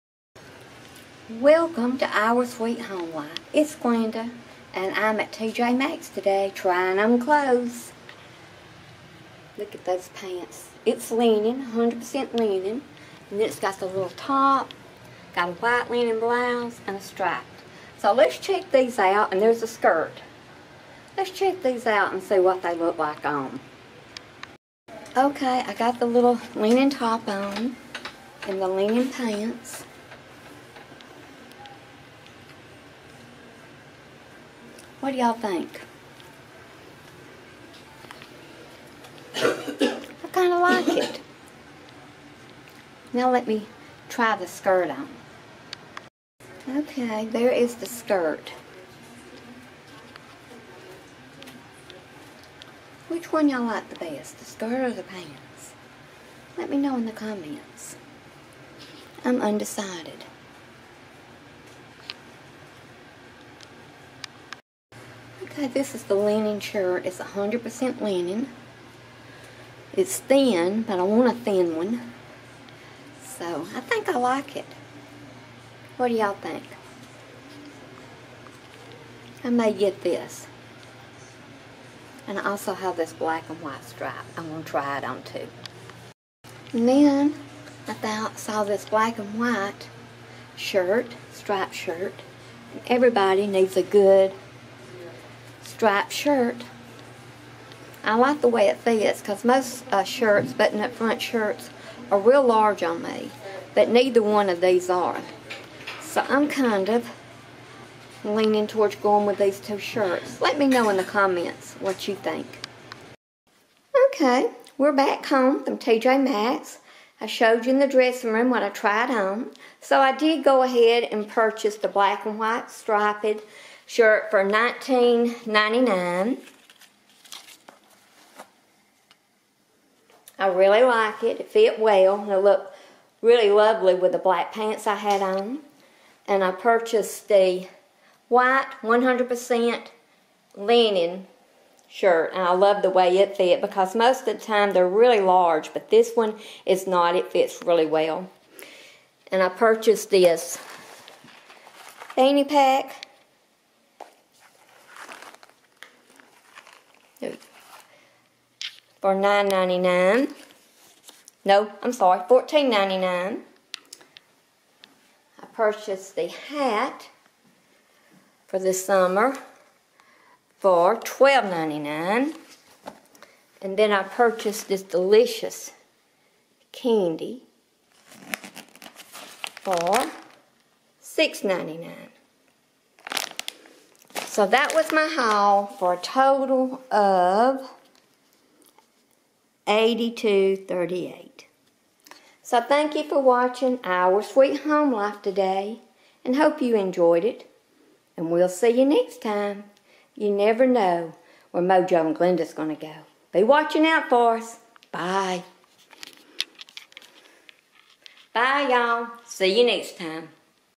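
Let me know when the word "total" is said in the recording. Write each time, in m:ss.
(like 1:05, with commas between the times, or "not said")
3:05.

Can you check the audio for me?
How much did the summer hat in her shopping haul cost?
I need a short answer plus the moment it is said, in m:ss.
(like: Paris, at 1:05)
$12.99, at 2:50.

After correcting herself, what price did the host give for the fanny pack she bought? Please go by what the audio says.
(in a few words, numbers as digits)
$14.99.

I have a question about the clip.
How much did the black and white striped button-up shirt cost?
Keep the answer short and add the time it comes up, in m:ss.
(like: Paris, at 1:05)
$19.99, at 2:04.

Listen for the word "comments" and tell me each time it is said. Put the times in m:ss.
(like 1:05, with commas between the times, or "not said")
0:57, 1:51.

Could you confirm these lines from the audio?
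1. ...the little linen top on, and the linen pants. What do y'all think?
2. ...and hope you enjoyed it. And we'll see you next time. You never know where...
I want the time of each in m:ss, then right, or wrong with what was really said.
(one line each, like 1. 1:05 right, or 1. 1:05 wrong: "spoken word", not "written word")
1. 0:25 right
2. 3:16 right.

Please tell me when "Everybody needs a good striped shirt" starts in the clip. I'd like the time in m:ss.
1:32.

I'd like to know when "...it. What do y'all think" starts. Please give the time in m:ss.
1:14.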